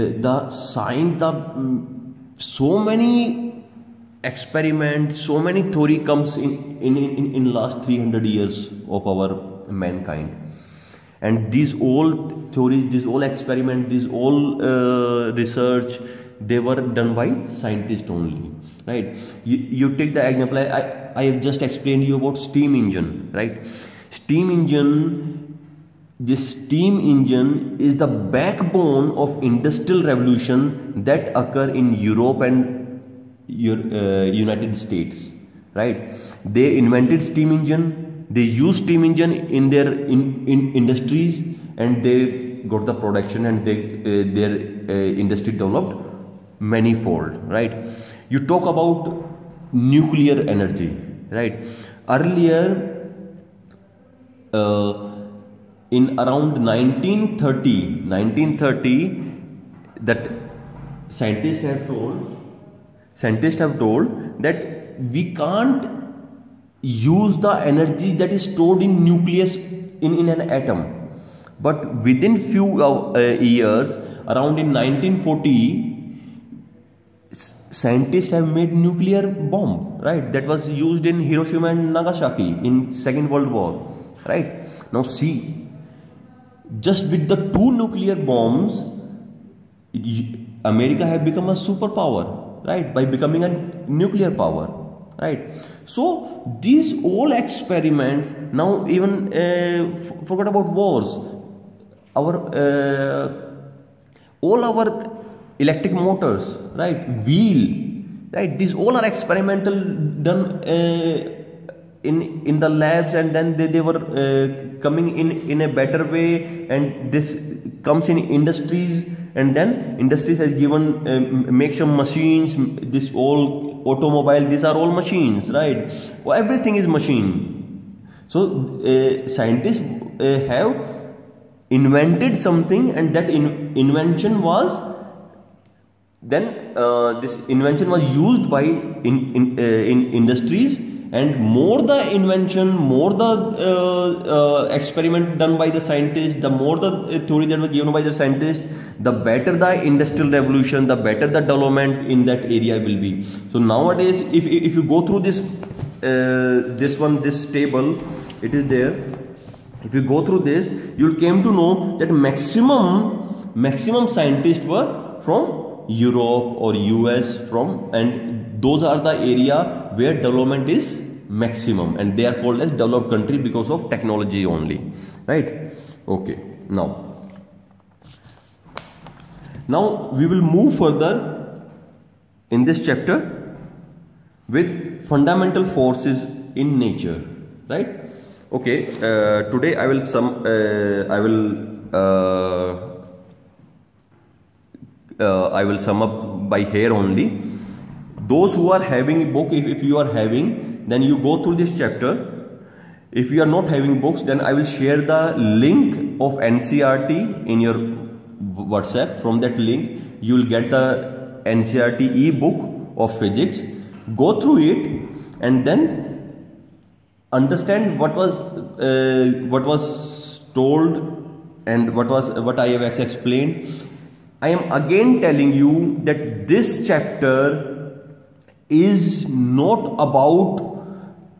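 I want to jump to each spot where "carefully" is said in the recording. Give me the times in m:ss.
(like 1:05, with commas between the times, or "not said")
not said.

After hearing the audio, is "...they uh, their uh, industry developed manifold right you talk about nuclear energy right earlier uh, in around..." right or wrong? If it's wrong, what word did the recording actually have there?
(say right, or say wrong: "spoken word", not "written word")
right.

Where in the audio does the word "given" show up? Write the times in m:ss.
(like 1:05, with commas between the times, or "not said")
2:00, 2:27.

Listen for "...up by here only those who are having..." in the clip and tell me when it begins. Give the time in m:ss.
3:16.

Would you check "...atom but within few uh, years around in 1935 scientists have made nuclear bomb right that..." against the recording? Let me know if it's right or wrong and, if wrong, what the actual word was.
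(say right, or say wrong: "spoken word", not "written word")
wrong: "1940", not "1935".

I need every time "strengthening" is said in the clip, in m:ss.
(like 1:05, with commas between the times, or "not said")
not said.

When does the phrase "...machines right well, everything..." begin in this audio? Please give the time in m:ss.
2:04.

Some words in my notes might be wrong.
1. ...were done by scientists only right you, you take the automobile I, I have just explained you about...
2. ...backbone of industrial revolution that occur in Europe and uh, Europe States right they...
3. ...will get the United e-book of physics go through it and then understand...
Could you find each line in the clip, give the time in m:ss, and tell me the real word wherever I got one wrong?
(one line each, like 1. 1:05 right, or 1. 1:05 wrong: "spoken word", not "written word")
1. 0:16 wrong: "example", not "automobile"
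2. 0:28 wrong: "United", not "Europe"
3. 3:30 wrong: "NCERT", not "United".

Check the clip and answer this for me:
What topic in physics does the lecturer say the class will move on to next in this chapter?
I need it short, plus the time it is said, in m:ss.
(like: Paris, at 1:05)
Fundamental forces in nature, at 3:05.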